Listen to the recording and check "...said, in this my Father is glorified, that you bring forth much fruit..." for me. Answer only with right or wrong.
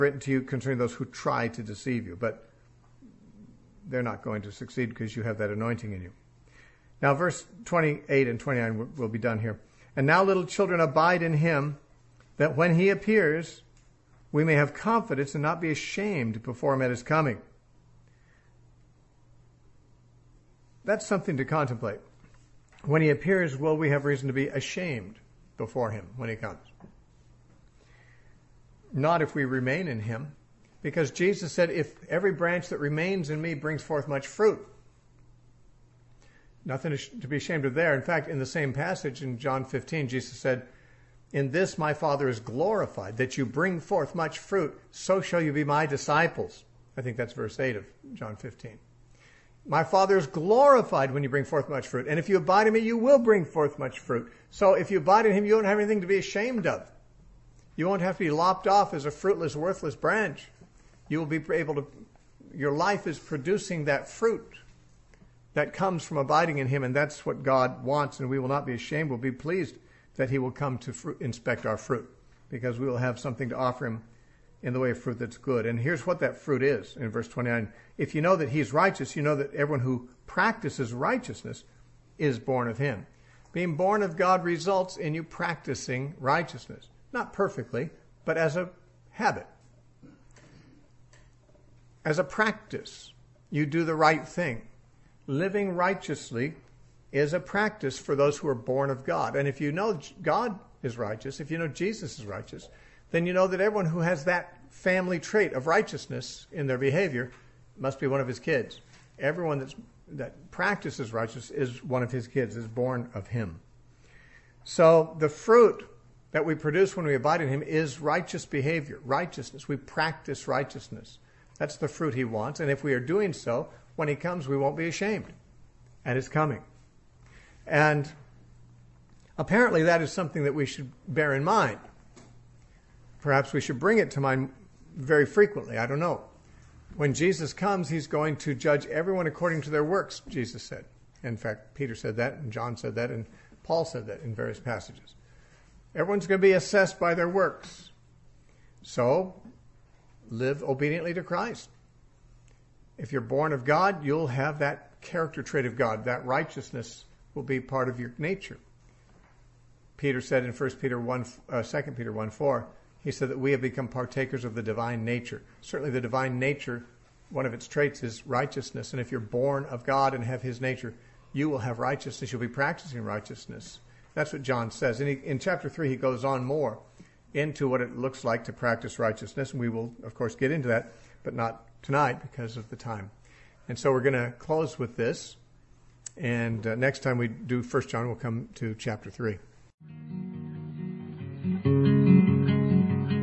right.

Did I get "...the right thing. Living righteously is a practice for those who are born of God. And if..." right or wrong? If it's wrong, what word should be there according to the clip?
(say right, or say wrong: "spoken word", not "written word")
right.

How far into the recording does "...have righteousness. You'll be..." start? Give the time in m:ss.
2:51.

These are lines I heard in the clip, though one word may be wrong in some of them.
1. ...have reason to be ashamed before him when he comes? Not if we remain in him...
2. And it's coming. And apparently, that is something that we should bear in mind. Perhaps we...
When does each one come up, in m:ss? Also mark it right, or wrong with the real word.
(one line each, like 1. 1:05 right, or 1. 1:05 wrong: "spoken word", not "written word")
1. 0:23 right
2. 2:06 right.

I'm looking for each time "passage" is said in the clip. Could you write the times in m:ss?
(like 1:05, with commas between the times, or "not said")
0:38, 2:24.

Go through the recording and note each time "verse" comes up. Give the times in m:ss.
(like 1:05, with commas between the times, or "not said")
0:07, 0:47, 1:17.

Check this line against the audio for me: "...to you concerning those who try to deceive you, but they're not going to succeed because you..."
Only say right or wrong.
right.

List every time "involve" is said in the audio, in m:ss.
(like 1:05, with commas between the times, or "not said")
not said.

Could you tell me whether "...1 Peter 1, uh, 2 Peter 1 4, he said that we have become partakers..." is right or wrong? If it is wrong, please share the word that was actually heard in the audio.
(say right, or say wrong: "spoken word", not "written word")
right.